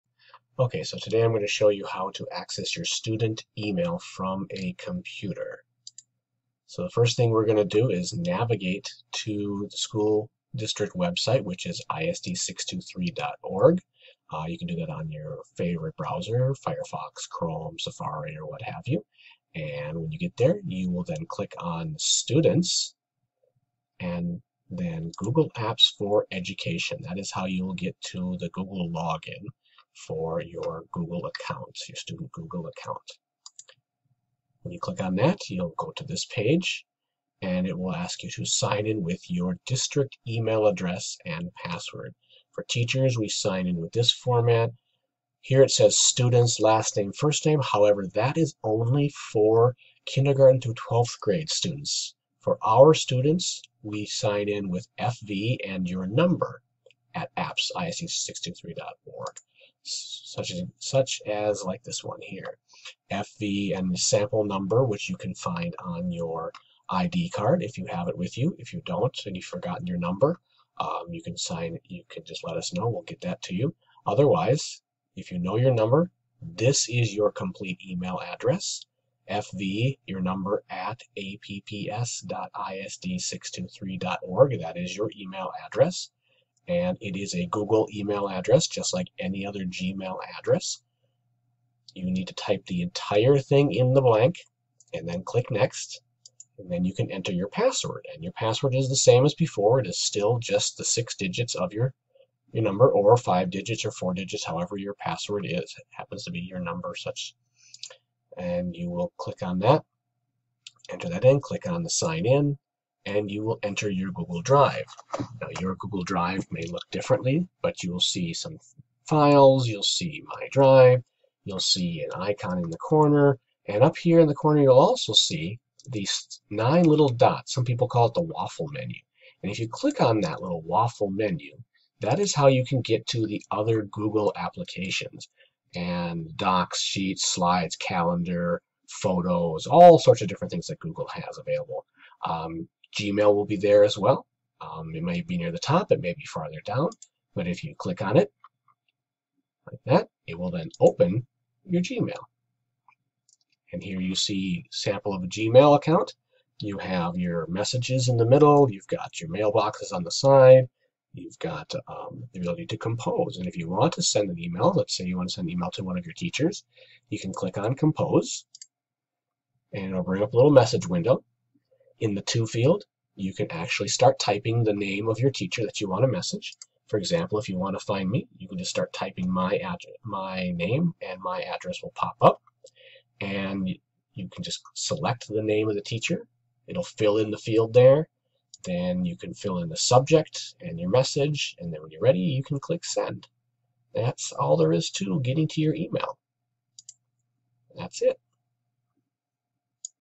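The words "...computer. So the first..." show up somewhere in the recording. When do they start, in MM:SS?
00:04.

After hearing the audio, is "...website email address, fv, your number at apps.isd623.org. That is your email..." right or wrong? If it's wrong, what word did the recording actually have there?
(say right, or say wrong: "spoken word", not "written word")
wrong: "complete", not "website".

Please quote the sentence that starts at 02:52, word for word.
In the to field, you can actually start typing the name of your teacher that you want to message.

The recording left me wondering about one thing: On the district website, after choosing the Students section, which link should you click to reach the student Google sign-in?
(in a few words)
Google Apps for Education.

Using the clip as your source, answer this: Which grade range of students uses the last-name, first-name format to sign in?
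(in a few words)
Kindergarten through 12th grade.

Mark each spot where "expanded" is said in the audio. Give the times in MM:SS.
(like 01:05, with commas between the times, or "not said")
not said.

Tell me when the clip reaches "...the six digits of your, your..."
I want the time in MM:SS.
01:40.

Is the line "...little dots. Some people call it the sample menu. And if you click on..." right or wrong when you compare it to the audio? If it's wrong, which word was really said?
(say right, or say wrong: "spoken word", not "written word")
wrong: "waffle", not "sample".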